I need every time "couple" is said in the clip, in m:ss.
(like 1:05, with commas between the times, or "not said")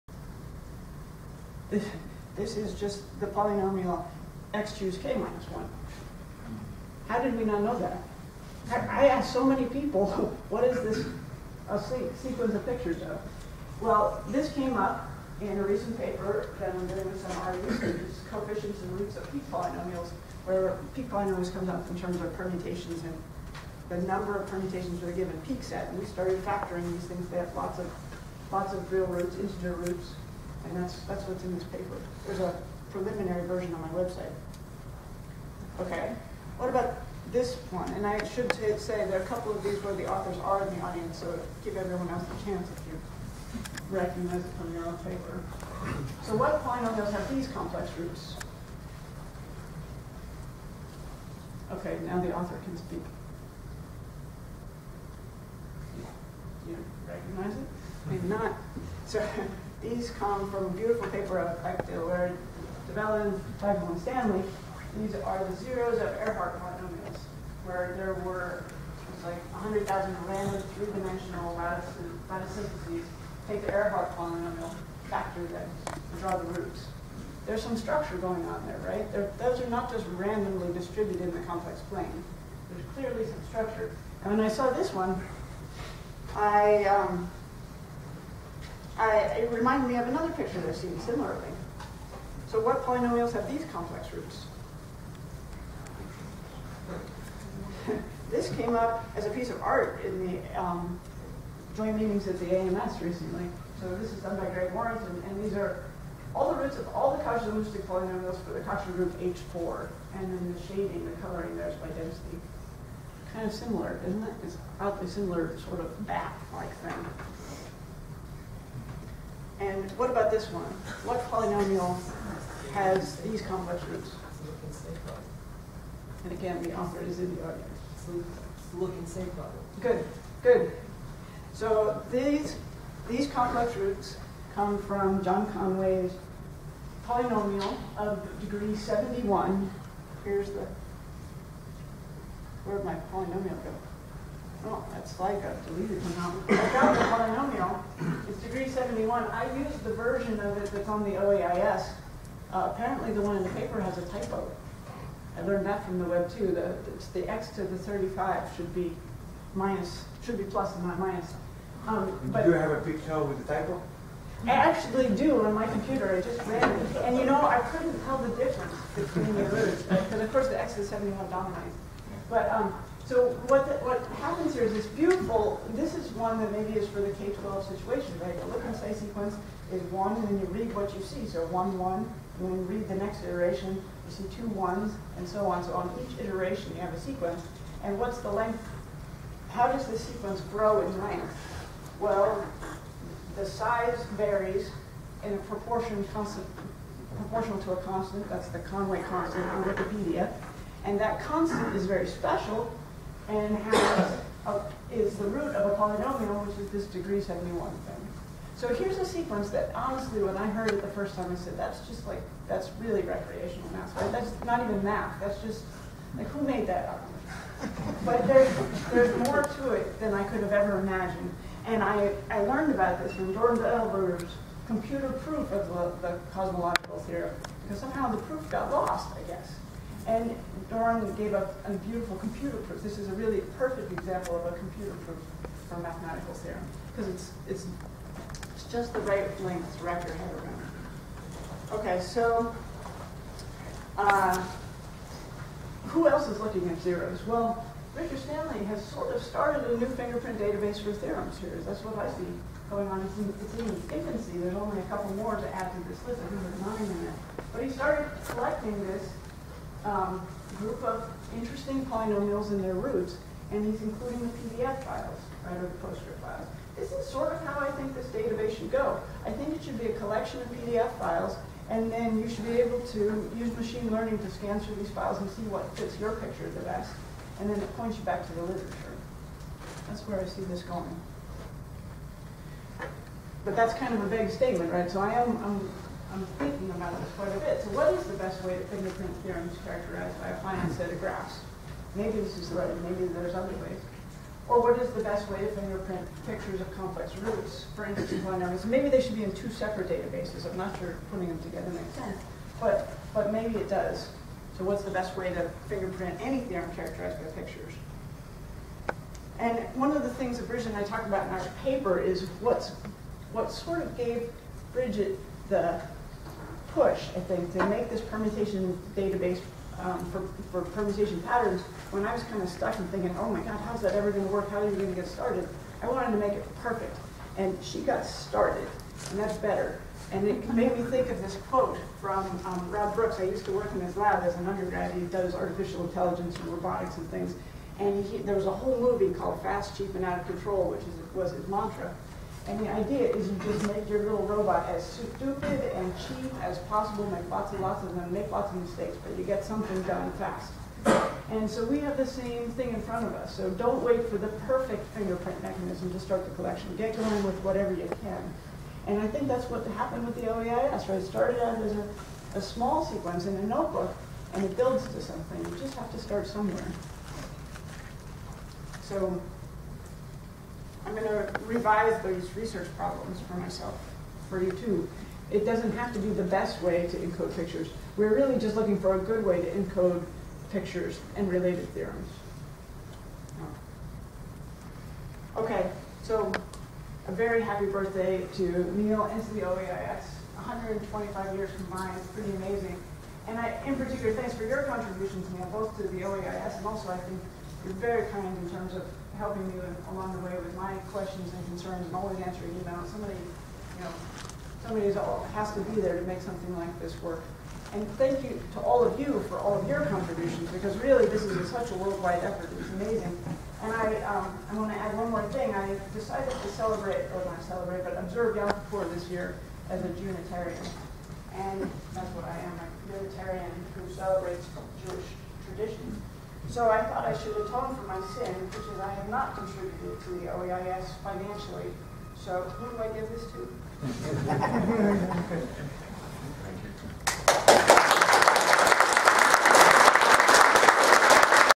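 0:39, 4:14.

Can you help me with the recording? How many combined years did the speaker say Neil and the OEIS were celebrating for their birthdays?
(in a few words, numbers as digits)
125.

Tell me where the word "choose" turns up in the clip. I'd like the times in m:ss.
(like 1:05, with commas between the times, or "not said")
0:04.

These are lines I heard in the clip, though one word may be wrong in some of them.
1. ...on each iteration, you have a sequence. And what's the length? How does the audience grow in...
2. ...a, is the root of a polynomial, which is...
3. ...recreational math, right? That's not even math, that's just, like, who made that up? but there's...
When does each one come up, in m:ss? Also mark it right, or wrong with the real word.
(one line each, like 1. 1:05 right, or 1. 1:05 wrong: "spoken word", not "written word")
1. 3:05 wrong: "sequence", not "audience"
2. 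3:24 right
3. 3:33 right.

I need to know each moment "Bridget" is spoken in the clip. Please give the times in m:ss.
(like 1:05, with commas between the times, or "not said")
5:10, 5:14.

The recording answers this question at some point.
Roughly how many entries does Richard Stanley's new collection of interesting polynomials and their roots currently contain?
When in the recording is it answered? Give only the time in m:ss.
4:16.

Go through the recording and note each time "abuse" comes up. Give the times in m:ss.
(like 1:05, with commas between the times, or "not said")
not said.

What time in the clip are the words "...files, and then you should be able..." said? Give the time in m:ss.
4:30.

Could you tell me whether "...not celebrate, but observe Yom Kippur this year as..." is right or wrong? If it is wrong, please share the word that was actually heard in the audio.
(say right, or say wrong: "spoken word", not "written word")
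right.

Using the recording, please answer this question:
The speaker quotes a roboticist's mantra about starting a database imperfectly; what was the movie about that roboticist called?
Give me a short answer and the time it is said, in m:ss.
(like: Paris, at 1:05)
Fast, Cheap, and Out of Control, at 5:39.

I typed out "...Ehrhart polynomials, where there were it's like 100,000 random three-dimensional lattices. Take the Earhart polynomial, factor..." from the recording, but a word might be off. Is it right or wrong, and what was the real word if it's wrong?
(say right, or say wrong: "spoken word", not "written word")
right.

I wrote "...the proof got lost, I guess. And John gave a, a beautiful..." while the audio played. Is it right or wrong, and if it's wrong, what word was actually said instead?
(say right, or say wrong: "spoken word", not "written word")
wrong: "Doron", not "John".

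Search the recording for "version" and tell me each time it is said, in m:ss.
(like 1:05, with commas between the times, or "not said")
0:33, 2:29.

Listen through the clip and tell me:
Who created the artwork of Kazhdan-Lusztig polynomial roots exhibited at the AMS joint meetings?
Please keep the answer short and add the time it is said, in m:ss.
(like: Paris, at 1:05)
Greg Warrington, at 1:44.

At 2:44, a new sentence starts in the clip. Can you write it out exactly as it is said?
I actually do on my computer.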